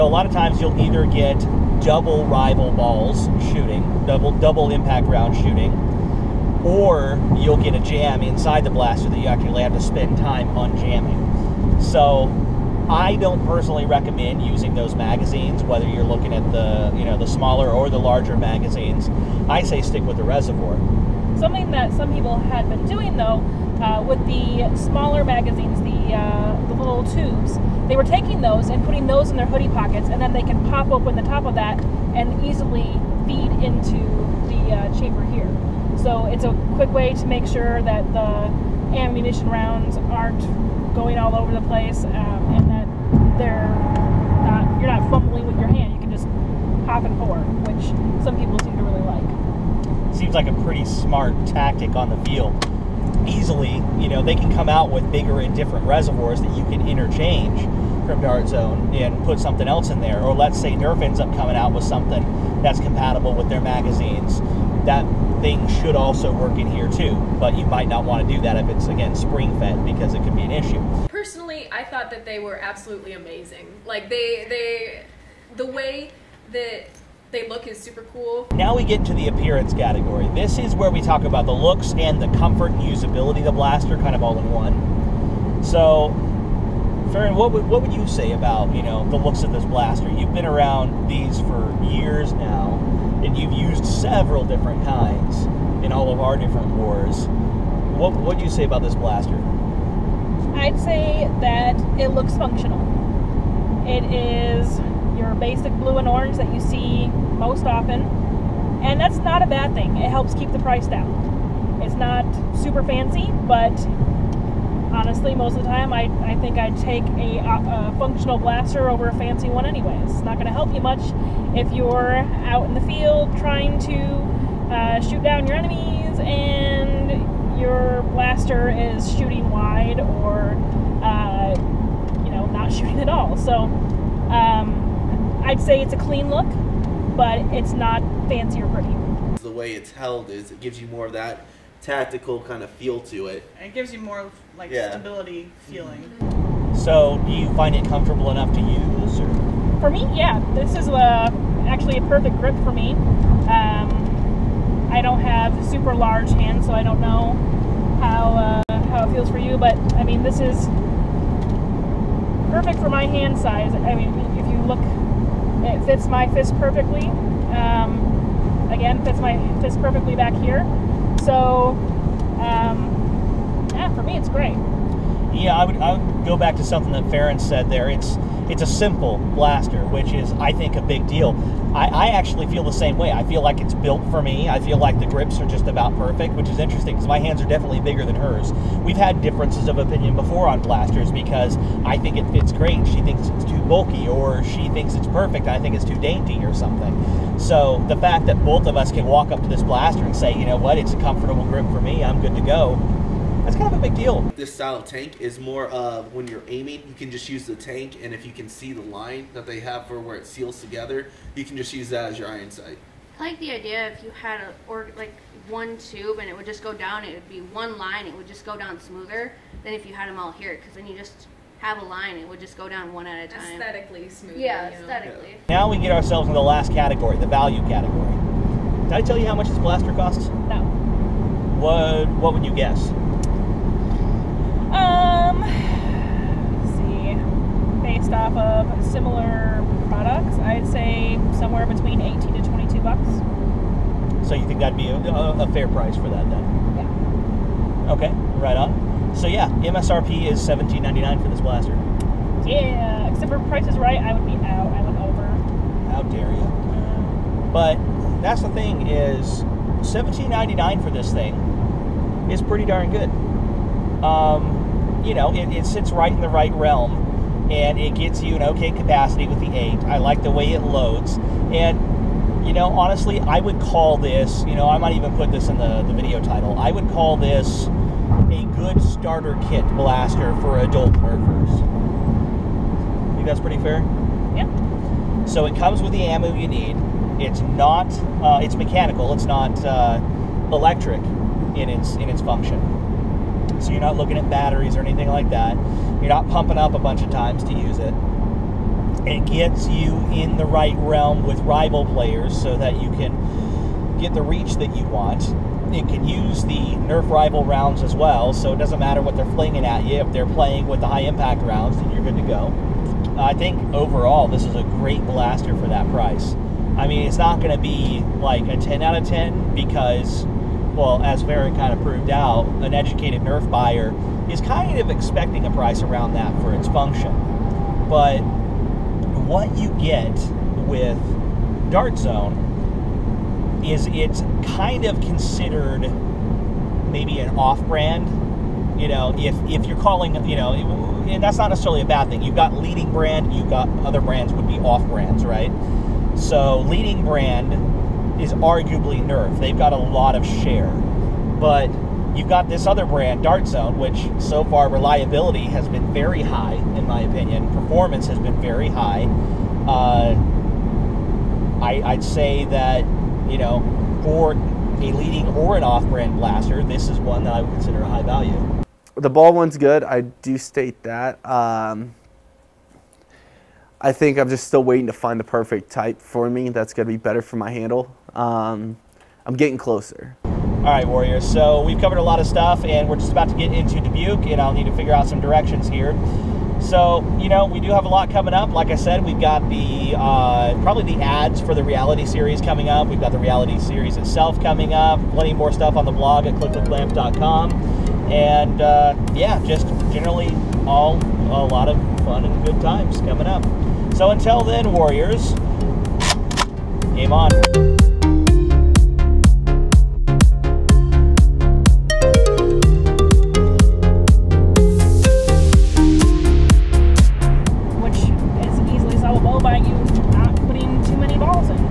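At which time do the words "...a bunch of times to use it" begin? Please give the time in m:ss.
4:56.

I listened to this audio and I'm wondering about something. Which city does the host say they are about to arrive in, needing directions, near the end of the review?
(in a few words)
Dubuque.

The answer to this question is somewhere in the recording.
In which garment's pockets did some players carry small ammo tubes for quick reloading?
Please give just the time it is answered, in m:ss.
0:29.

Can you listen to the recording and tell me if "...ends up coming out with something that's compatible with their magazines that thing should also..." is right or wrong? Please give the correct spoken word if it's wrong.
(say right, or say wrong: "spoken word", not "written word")
right.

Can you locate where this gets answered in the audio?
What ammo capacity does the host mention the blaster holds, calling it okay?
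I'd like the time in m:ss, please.
4:29.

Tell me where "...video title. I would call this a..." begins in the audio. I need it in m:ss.
4:35.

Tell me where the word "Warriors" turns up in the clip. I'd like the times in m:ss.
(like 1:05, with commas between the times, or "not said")
6:20, 6:44.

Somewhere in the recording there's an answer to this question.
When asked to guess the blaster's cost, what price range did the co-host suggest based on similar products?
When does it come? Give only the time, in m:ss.
4:01.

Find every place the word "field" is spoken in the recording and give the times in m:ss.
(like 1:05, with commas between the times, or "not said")
0:52, 2:02.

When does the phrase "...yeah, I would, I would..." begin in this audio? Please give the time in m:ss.
2:55.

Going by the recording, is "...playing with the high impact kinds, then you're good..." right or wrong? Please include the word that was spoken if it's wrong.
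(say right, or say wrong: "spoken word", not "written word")
wrong: "rounds", not "kinds".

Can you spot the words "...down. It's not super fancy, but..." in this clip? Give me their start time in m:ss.
1:50.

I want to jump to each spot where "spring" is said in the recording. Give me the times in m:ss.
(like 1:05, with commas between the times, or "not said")
1:09.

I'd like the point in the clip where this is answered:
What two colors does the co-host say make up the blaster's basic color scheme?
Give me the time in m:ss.
1:45.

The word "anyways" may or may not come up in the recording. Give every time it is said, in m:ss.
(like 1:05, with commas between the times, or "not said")
1:59.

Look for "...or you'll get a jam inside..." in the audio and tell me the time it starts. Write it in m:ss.
0:06.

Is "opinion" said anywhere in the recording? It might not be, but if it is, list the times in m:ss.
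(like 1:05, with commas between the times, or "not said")
3:09, 5:57.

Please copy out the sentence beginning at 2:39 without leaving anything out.
But I mean, this is perfect for my hand size.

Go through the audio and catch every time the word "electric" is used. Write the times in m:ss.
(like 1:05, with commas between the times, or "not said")
4:50.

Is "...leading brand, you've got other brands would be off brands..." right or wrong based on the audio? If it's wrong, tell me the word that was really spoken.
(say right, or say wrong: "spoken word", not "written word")
right.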